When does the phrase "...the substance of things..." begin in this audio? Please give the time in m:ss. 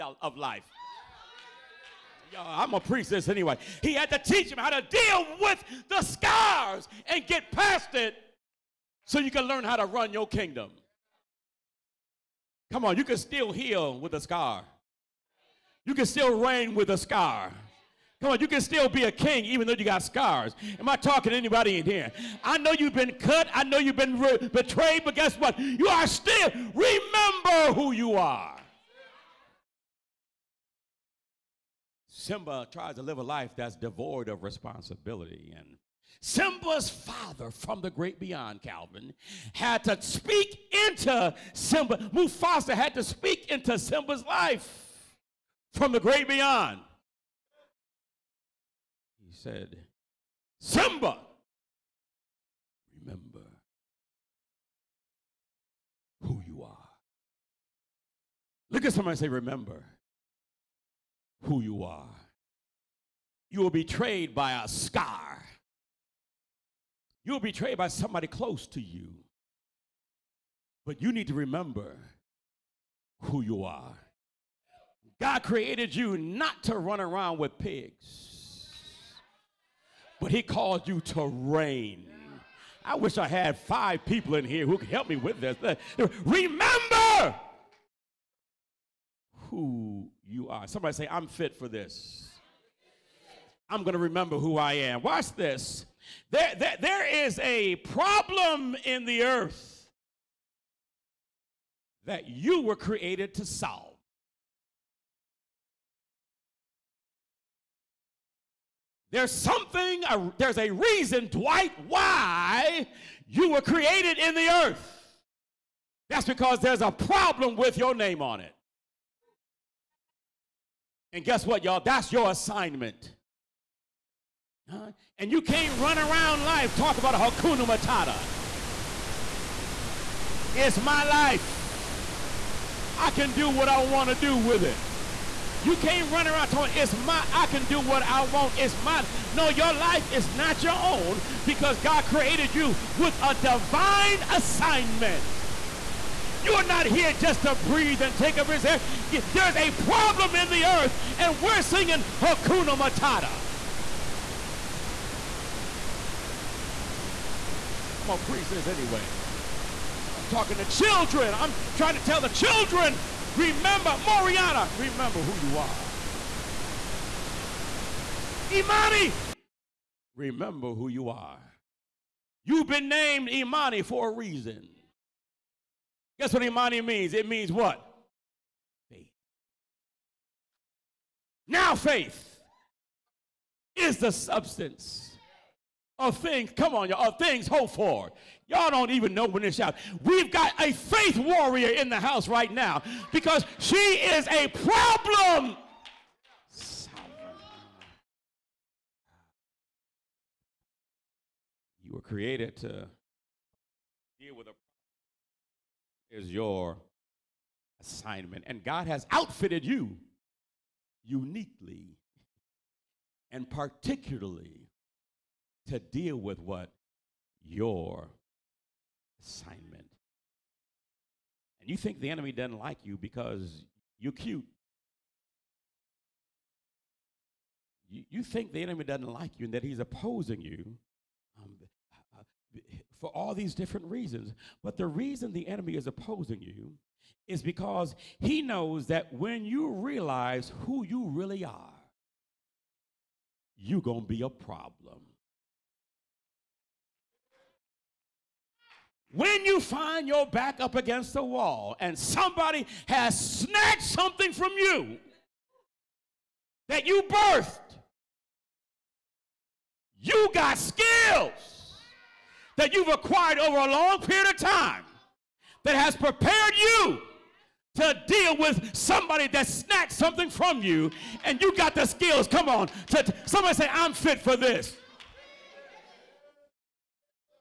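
3:03.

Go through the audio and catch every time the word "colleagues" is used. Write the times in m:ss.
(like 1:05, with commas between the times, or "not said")
not said.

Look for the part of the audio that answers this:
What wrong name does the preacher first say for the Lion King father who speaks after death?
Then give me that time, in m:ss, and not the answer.
0:38.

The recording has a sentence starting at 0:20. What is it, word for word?
Am I talking to anybody in here?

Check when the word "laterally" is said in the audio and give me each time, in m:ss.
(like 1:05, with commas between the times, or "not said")
not said.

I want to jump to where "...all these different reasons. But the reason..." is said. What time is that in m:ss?
3:53.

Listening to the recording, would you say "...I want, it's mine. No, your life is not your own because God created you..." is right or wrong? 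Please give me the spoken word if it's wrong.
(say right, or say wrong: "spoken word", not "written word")
right.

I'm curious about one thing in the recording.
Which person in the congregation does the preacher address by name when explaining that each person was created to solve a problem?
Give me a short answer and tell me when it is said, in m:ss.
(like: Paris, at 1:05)
Dwight, at 1:51.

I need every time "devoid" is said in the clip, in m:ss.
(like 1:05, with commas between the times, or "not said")
0:33.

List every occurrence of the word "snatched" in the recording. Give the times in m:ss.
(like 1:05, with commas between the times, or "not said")
4:13, 4:29.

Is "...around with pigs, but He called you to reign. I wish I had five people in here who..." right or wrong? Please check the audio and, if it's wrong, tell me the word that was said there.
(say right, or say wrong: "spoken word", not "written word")
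right.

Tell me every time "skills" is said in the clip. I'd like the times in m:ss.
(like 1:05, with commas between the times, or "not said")
4:20, 4:31.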